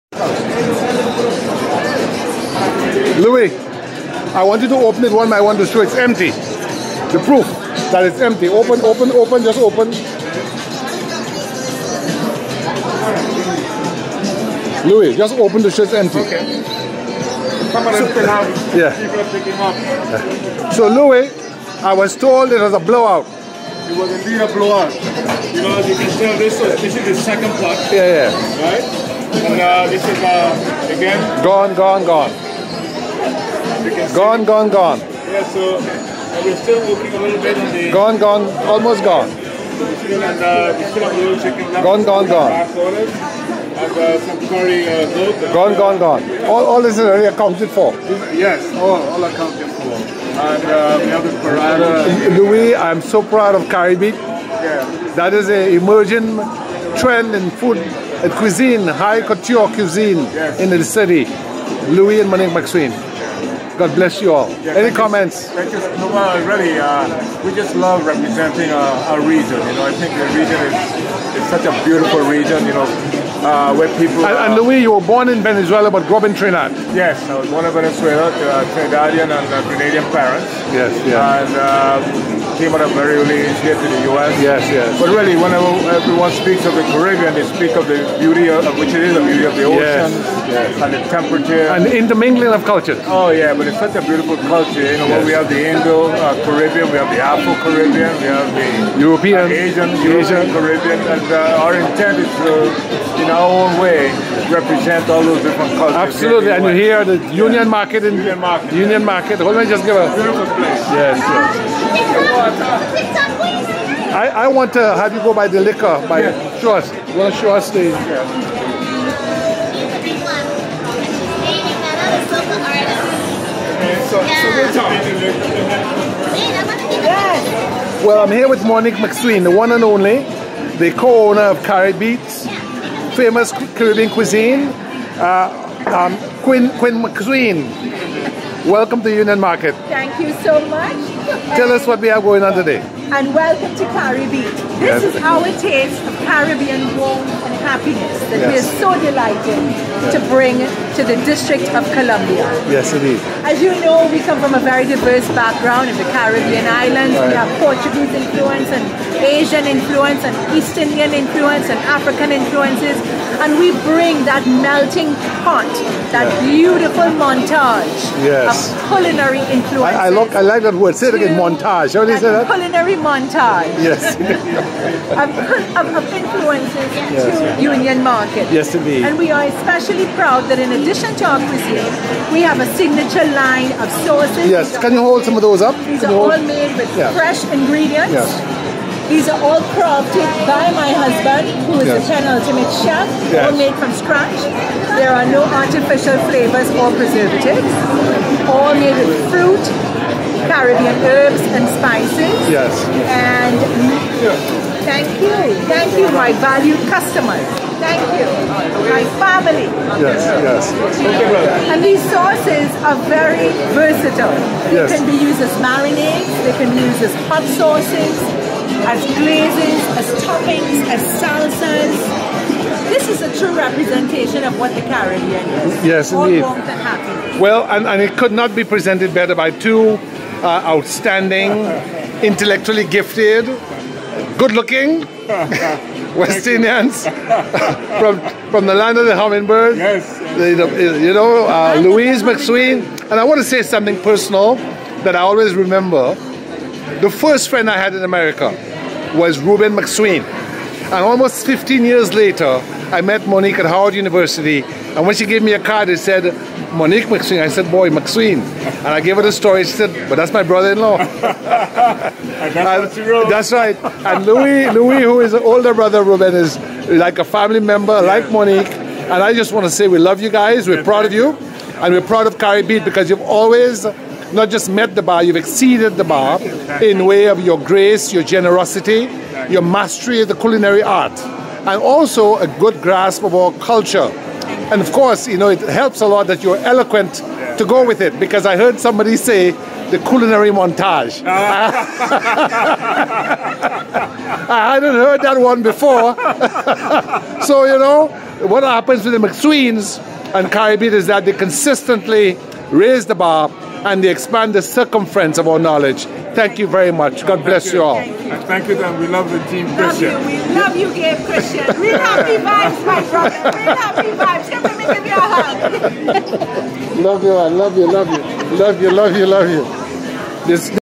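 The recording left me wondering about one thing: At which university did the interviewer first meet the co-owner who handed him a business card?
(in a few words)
Howard University.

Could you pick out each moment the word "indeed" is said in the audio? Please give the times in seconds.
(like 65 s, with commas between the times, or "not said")
24 s, 152 s, 178 s, 226 s.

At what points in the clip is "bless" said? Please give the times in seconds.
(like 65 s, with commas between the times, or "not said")
63 s, 307 s.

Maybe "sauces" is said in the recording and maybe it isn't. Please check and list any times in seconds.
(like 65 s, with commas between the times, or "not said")
184 s, 212 s, 217 s.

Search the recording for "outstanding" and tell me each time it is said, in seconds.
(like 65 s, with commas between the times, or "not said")
230 s.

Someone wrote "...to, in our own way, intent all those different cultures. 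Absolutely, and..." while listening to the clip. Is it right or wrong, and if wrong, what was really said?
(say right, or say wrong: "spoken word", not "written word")
wrong: "represent", not "intent".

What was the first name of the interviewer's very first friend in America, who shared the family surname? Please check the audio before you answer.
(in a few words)
Reuben.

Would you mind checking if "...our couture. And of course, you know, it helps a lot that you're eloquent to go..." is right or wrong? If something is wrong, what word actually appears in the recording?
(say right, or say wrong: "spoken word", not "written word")
wrong: "culture", not "couture".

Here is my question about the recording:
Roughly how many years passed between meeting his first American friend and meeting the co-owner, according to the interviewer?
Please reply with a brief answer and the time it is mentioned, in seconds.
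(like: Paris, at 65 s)
15, at 251 s.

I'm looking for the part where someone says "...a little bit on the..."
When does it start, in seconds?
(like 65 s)
37 s.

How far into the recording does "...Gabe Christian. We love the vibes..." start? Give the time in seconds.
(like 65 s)
310 s.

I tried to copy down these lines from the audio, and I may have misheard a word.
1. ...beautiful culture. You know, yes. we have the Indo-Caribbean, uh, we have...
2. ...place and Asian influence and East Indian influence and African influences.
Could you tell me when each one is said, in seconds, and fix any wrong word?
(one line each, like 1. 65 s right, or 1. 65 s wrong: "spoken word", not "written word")
1. 94 s right
2. 158 s wrong: "influence", not "place".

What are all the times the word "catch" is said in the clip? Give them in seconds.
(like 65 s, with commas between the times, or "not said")
not said.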